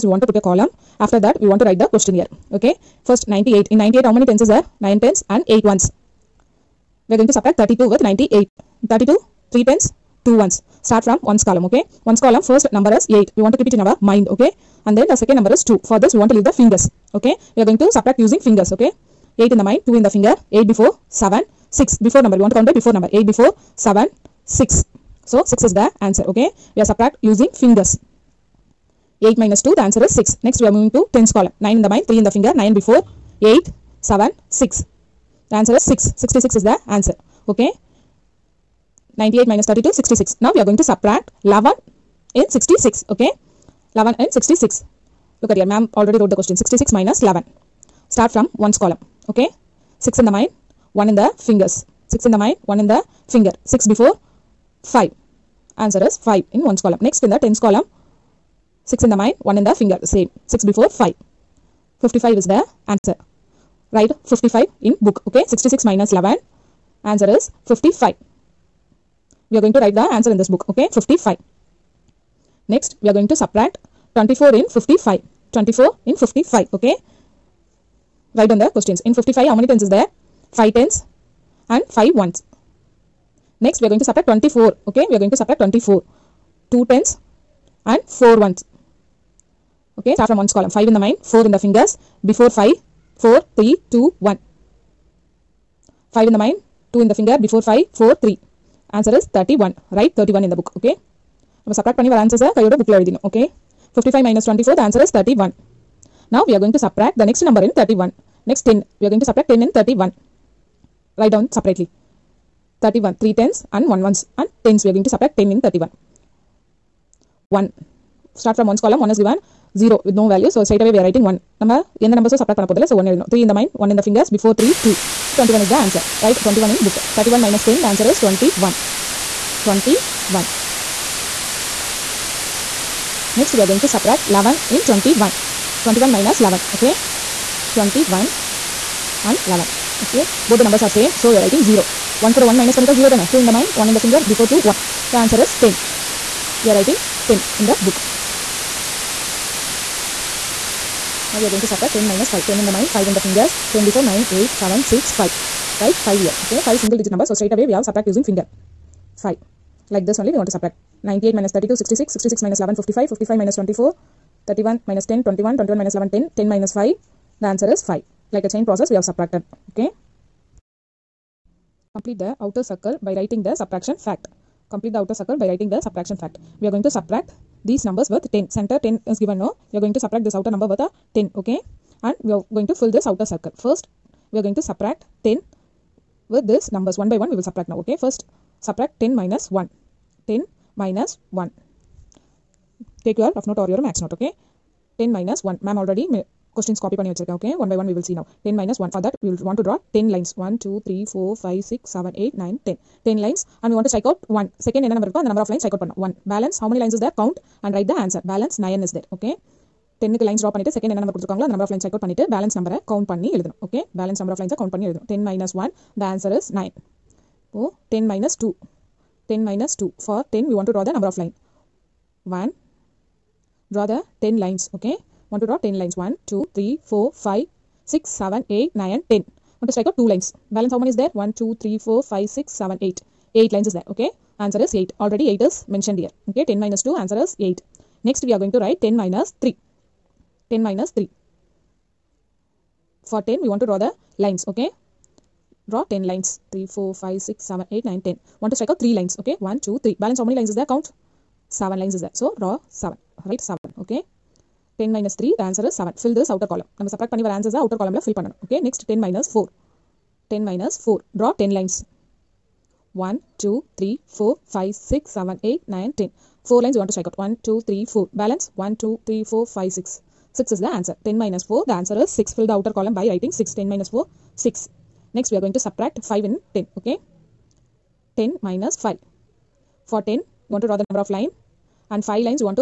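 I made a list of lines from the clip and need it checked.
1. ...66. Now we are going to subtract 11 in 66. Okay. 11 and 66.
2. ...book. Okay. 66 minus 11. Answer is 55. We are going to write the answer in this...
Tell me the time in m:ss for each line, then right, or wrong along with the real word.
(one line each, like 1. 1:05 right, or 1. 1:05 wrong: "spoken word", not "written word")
1. 0:39 right
2. 1:05 right.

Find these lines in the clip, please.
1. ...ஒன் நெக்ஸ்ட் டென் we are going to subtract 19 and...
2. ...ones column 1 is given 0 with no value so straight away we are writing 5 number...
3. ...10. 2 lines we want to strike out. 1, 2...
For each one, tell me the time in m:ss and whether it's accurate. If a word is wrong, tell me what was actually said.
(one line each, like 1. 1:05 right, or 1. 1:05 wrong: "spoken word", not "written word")
1. 1:48 wrong: "10", not "19"
2. 1:58 wrong: "1", not "5"
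3. 4:25 wrong: "4", not "2".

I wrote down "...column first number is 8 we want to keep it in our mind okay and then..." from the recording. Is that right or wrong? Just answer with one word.
right.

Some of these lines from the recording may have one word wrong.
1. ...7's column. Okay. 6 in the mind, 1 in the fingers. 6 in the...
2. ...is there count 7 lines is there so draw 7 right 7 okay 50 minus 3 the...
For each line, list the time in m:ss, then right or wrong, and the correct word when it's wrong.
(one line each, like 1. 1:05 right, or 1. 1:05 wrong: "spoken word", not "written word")
1. 0:48 wrong: "1", not "7"
2. 4:10 wrong: "10", not "50".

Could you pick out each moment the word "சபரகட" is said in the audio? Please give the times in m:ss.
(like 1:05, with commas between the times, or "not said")
1:41, 1:46, 2:02, 4:16.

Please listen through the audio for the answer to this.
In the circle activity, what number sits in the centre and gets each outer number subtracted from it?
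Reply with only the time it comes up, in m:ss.
2:58.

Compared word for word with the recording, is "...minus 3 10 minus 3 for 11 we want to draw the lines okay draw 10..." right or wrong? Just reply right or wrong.
wrong.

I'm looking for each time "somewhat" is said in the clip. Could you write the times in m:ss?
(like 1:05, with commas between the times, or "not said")
not said.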